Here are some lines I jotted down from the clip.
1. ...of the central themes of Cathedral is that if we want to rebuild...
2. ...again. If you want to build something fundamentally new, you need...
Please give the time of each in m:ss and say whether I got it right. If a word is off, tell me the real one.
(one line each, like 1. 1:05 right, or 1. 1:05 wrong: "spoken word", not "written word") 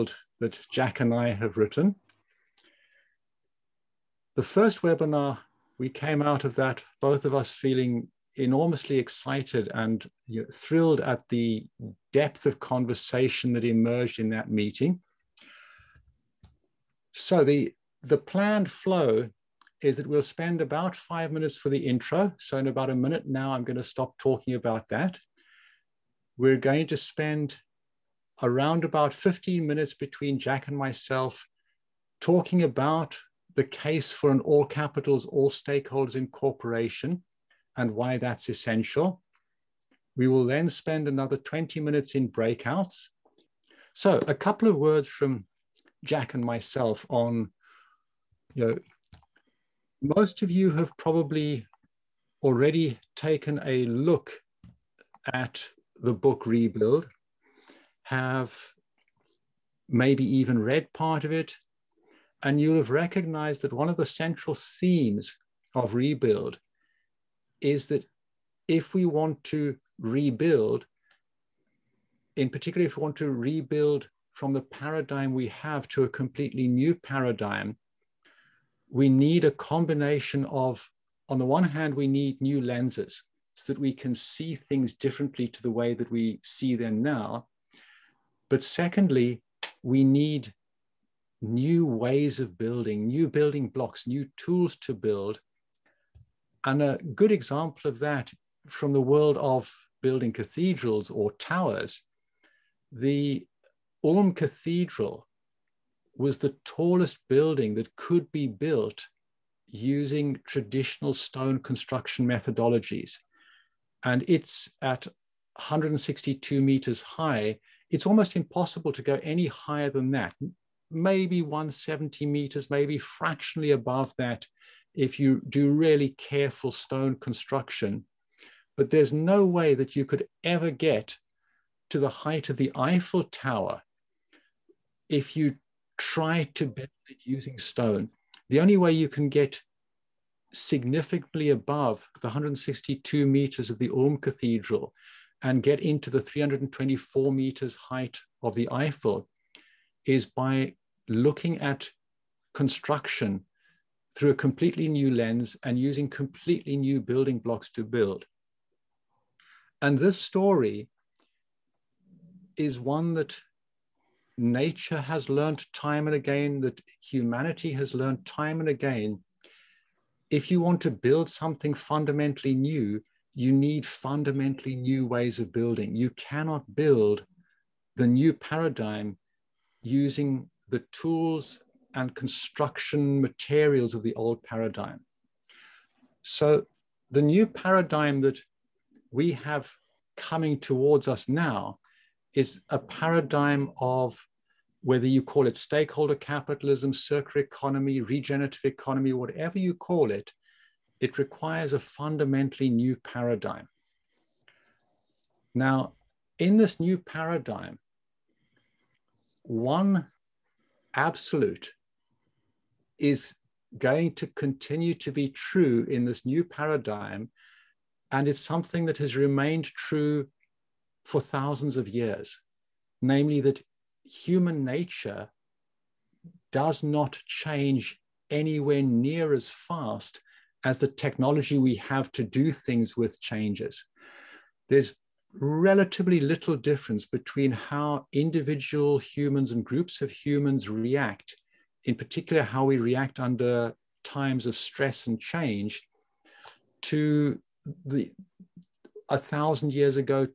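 1. 1:03 wrong: "Rebuild", not "Cathedral"
2. 2:48 right.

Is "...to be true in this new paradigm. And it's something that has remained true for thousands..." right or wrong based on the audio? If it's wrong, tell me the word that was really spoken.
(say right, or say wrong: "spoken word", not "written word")
right.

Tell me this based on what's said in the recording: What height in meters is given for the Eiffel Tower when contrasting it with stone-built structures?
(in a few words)
324 meters.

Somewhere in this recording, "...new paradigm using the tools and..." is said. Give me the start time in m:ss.
2:58.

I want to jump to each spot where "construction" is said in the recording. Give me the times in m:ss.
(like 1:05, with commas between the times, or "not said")
1:51, 2:07, 2:32, 3:02.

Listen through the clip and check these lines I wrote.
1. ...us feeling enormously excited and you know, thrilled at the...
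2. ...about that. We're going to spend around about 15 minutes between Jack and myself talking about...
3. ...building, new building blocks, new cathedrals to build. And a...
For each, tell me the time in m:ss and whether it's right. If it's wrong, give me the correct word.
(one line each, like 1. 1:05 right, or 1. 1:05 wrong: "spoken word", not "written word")
1. 0:07 right
2. 0:24 right
3. 1:32 wrong: "tools", not "cathedrals".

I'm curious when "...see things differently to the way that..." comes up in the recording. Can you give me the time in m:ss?
1:24.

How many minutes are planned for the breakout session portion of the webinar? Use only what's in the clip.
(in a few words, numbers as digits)
20.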